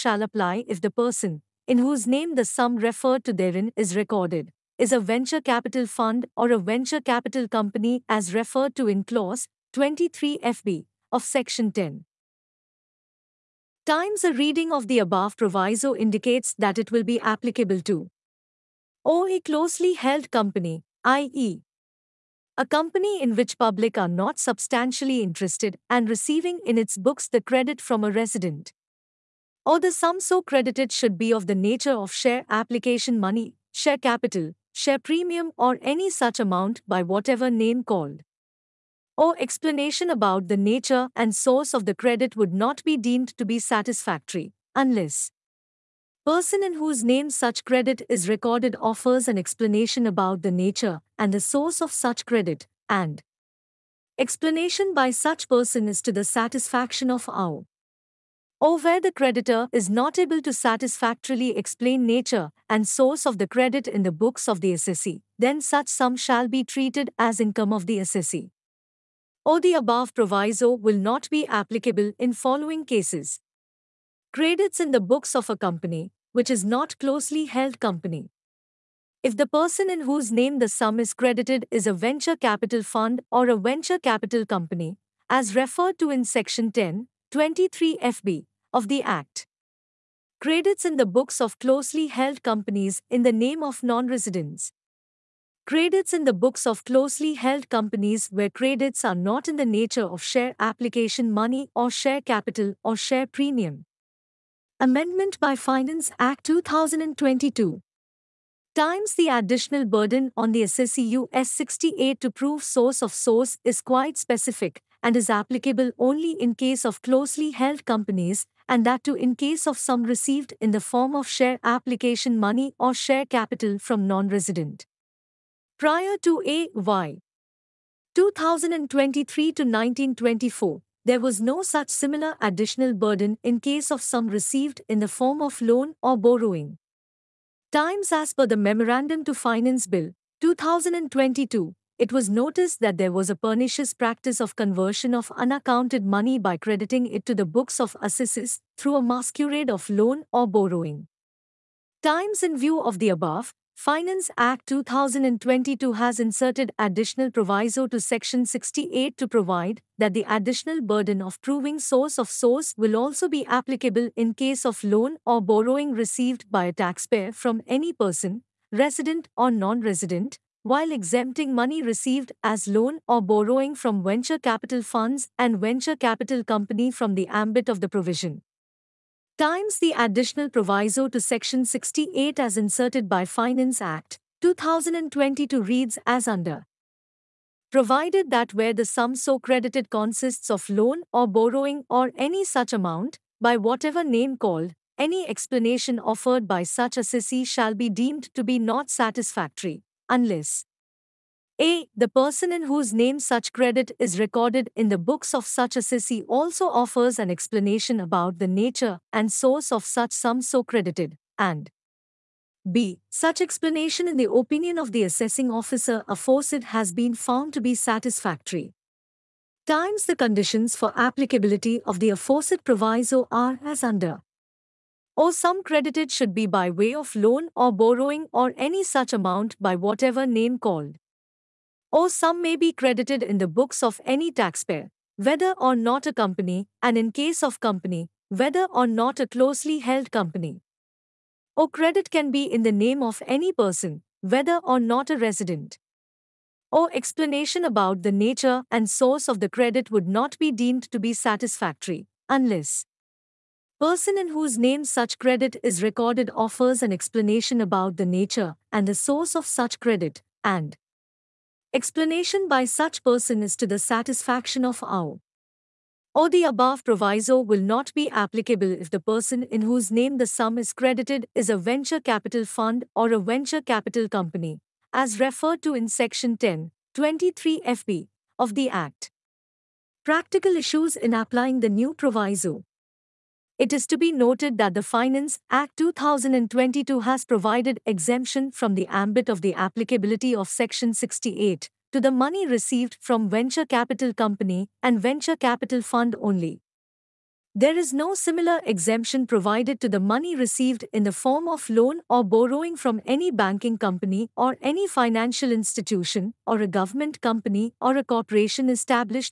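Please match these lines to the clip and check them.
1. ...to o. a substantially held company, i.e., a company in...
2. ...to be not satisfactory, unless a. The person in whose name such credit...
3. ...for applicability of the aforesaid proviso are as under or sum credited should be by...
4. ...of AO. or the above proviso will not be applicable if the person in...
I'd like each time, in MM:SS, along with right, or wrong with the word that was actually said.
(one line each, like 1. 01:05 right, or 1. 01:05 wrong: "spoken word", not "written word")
1. 00:17 wrong: "closely", not "substantially"
2. 03:18 right
3. 03:40 right
4. 04:24 right.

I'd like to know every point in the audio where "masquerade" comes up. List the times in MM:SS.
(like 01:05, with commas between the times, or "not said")
02:29.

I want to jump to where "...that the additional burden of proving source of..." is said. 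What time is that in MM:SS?
02:39.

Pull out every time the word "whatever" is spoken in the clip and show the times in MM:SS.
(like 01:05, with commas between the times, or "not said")
00:37, 03:13, 03:49.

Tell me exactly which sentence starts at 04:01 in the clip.
Or credit can be in the name of any person, whether or not a resident.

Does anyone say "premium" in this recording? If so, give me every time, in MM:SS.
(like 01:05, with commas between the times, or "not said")
00:34, 01:43.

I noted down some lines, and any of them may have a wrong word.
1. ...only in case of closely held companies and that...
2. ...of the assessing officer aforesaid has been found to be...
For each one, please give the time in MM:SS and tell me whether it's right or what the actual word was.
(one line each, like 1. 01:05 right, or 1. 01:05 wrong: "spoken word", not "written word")
1. 01:55 right
2. 03:34 right.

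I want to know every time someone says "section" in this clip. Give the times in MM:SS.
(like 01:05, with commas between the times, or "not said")
00:11, 01:26, 02:37, 03:01, 04:35, 04:50.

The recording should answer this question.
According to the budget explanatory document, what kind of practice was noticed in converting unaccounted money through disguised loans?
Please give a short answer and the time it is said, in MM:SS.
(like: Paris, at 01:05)
pernicious practice, at 02:23.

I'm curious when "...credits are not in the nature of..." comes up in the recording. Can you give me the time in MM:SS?
01:38.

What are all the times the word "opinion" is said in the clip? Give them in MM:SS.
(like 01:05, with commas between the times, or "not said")
03:34.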